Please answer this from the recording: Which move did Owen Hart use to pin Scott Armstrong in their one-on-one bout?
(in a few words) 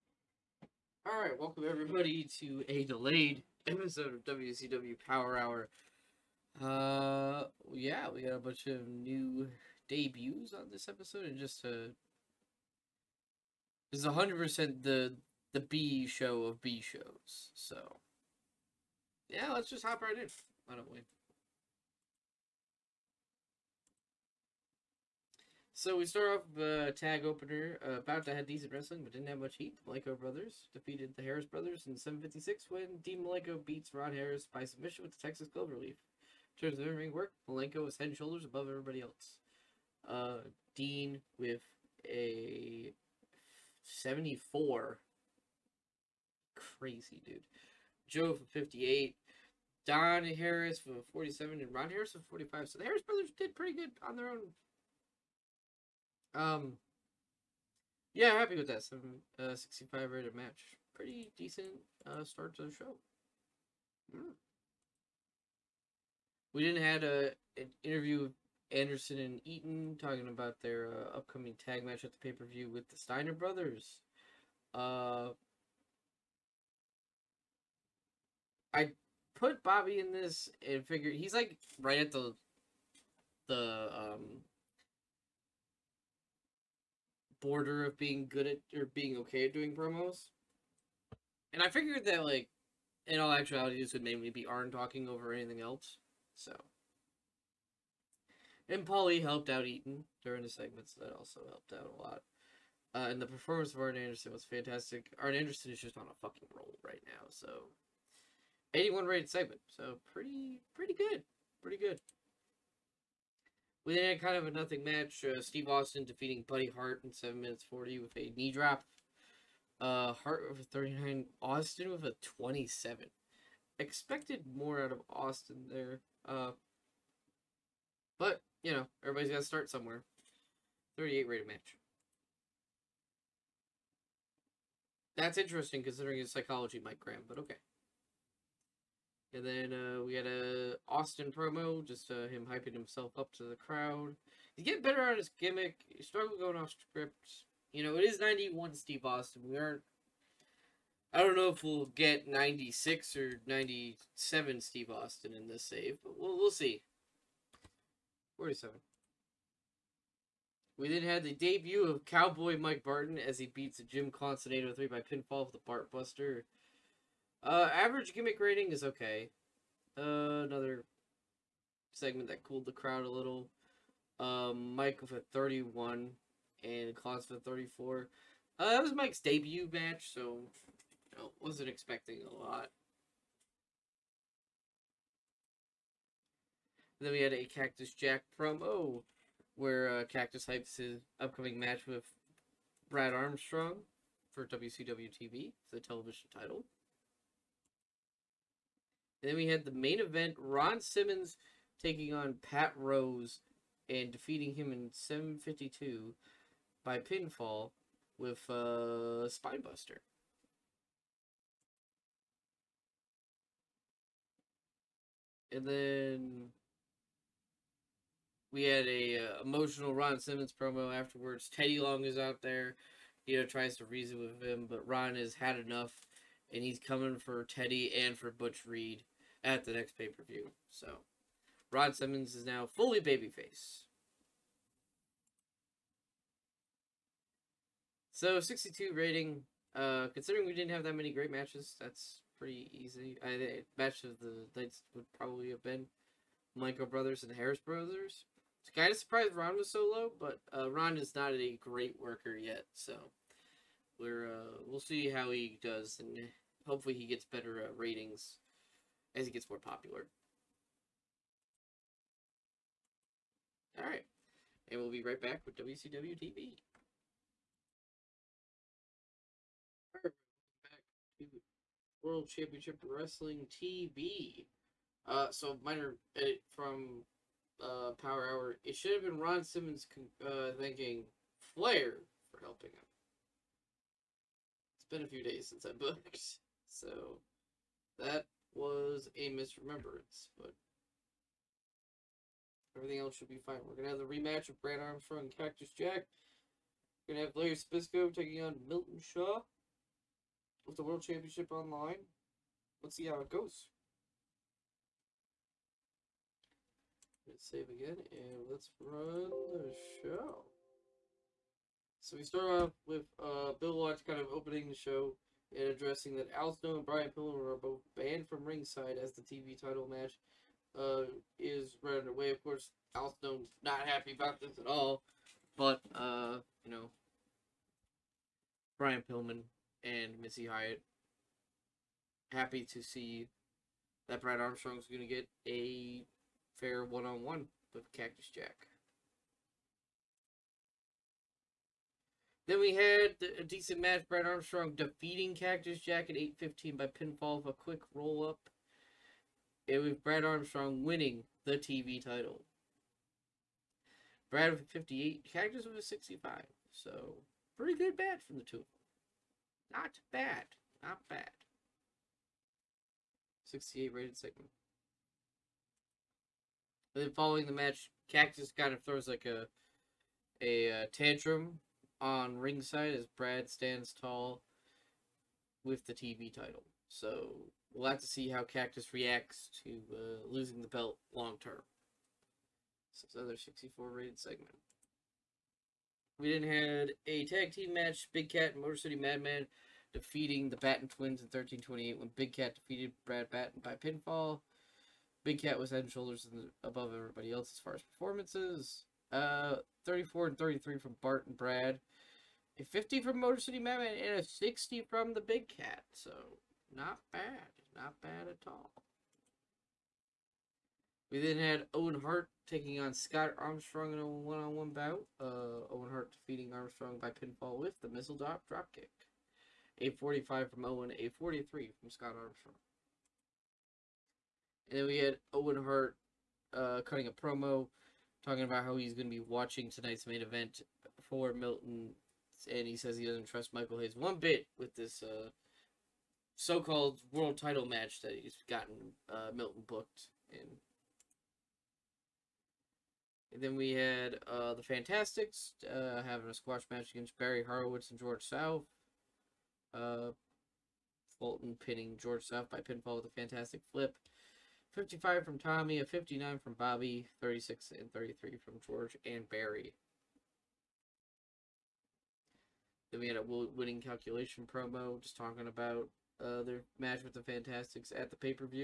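missile drop dropkick.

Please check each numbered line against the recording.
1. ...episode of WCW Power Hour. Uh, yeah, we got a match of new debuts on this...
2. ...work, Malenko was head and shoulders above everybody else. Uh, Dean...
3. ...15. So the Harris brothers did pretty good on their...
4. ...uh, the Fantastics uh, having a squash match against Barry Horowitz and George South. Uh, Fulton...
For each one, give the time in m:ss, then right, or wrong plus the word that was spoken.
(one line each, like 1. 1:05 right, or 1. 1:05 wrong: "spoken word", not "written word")
1. 0:03 wrong: "bunch", not "match"
2. 0:37 right
3. 0:52 wrong: "45", not "15"
4. 7:24 right.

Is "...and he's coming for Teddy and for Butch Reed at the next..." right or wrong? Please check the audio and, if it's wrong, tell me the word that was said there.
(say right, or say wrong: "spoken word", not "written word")
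right.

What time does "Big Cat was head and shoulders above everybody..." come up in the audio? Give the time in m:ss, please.
6:35.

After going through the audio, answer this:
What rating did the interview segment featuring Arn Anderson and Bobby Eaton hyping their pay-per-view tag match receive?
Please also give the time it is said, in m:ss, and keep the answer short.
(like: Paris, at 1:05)
81, at 1:48.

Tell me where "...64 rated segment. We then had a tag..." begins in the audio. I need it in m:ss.
6:23.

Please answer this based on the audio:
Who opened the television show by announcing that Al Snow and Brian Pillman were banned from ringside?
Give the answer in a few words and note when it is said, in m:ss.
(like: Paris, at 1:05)
Bill Watts, at 5:13.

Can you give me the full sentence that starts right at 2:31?
I don't know if we'll get 96 or 97 Steve Austin in this save, but we'll, we'll see.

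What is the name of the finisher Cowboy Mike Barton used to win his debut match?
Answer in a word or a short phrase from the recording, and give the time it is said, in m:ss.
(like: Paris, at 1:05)
Bartbuster, at 2:45.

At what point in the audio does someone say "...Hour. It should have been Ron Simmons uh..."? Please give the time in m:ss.
4:38.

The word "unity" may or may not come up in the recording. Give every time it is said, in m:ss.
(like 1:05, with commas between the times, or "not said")
not said.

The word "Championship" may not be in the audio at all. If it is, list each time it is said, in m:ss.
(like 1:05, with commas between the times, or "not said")
4:32, 5:01.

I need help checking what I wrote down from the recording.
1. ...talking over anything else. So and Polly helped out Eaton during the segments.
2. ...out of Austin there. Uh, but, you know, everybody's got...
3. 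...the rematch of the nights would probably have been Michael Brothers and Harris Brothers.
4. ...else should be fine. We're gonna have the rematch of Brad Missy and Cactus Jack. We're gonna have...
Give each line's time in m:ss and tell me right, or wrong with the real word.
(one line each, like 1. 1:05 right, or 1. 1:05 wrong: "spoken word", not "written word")
1. 1:34 right
2. 2:04 right
3. 4:03 wrong: "match", not "rematch"
4. 4:52 wrong: "Armstrong", not "Missy".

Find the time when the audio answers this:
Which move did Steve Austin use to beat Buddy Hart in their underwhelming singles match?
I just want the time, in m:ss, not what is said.
1:58.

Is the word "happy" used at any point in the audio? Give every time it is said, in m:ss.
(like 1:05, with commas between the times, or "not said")
0:58, 5:23, 5:32.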